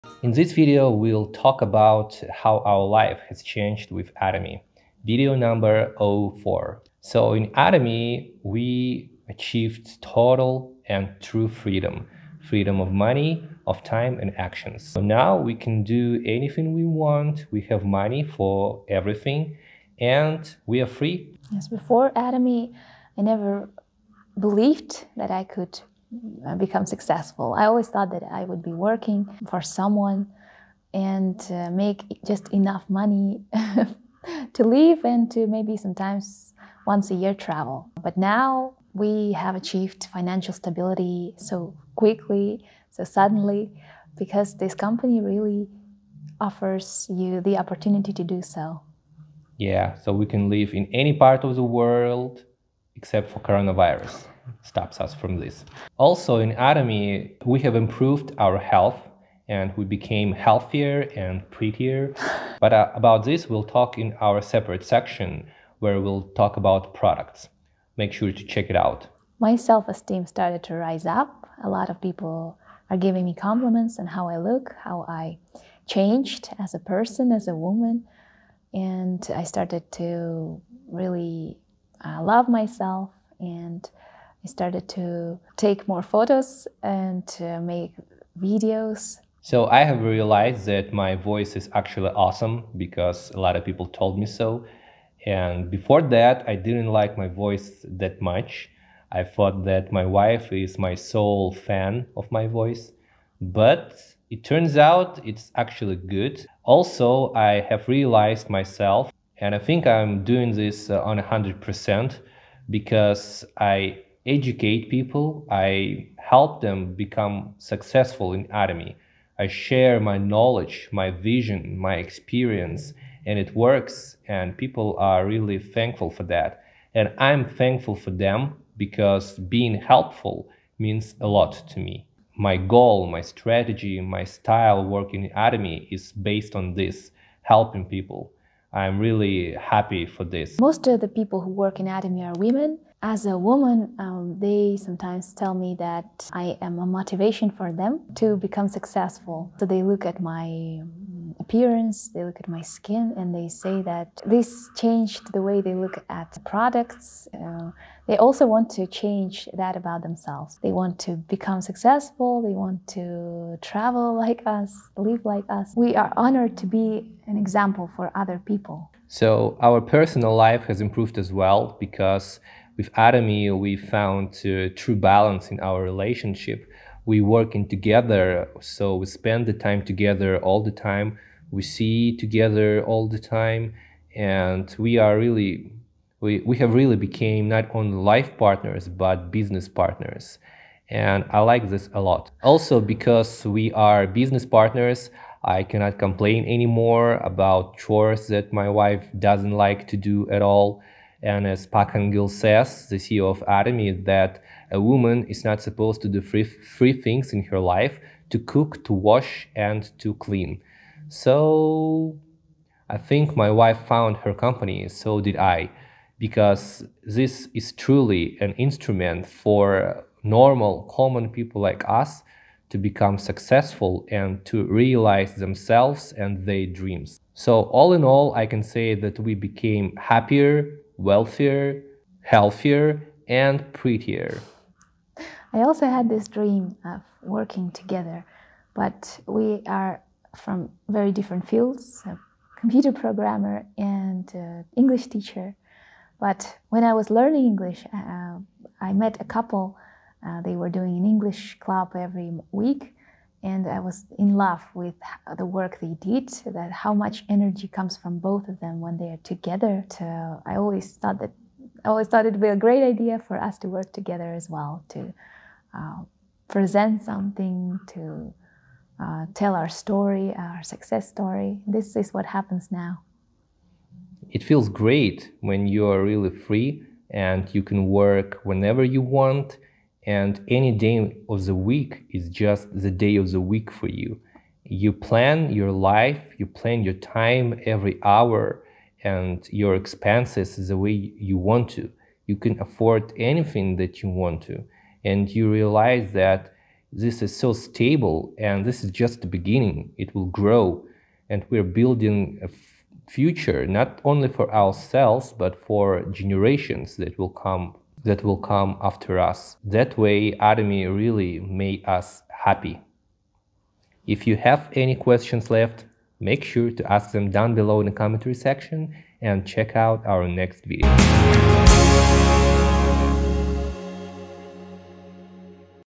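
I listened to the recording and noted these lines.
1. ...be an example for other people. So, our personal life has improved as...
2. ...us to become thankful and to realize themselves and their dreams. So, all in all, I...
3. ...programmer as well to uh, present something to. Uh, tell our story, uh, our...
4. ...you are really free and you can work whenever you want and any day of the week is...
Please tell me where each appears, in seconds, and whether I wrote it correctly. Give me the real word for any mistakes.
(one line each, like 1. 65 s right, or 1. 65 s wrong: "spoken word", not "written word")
1. 166 s right
2. 221 s wrong: "successful", not "thankful"
3. 263 s wrong: "together", not "programmer"
4. 275 s right.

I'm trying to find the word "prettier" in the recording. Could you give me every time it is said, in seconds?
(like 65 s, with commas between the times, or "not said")
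61 s, 233 s.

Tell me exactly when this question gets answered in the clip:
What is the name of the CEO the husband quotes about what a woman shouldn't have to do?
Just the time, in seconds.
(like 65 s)
201 s.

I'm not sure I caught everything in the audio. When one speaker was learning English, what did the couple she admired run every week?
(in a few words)
an English club.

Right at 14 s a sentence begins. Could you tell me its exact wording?
So now we can do anything we want.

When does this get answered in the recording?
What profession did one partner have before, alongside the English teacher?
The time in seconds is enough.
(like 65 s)
242 s.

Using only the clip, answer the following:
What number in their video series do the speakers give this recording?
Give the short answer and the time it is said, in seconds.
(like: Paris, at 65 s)
04, at 5 s.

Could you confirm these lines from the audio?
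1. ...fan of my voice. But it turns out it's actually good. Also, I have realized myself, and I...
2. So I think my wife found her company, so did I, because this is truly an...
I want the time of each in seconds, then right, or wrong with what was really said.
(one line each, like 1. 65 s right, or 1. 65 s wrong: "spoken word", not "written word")
1. 101 s right
2. 211 s right.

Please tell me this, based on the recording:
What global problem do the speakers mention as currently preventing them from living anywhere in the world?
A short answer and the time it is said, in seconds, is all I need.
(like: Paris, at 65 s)
coronavirus, at 53 s.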